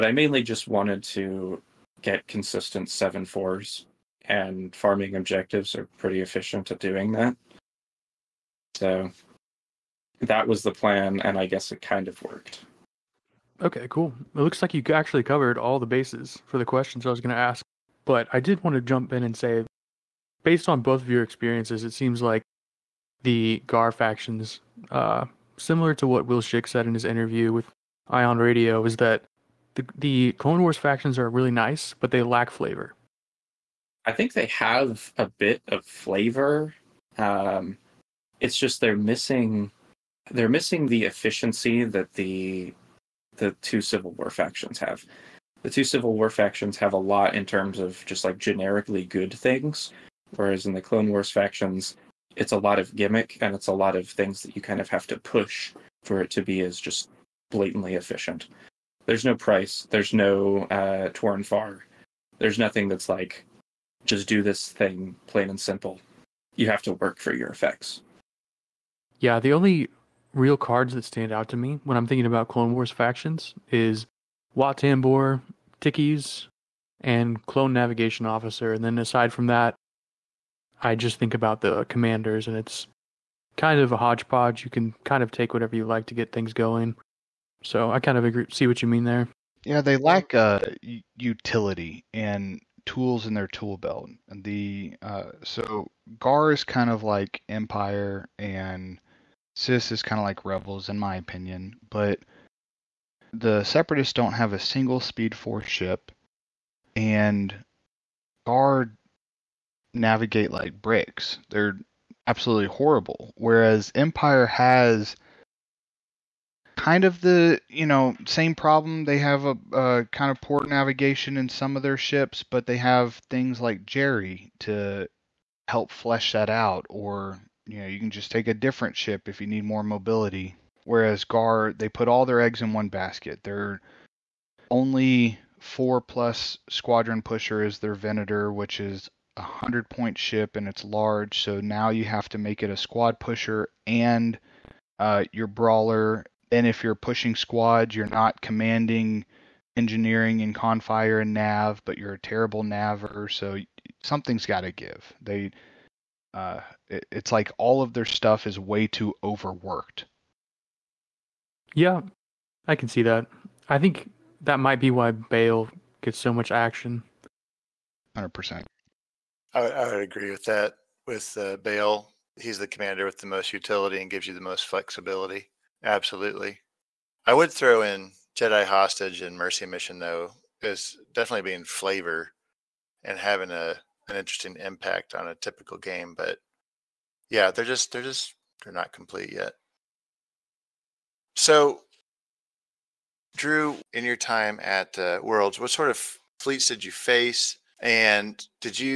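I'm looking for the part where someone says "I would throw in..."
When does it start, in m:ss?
2:57.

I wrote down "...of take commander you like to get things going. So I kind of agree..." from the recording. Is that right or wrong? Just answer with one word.
wrong.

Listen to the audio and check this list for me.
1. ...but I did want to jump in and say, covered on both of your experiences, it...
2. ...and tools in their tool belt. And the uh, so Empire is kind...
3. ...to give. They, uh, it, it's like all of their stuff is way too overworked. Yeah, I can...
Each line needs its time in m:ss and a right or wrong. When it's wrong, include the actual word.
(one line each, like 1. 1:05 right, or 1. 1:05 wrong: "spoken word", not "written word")
1. 0:18 wrong: "based", not "covered"
2. 1:32 wrong: "Gar", not "Empire"
3. 2:34 right.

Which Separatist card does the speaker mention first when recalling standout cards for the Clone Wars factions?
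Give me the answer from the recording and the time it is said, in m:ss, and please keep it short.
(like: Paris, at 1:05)
Wat Tambor, at 1:14.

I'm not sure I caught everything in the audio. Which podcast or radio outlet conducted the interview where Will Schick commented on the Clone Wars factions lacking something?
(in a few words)
Ion Radio.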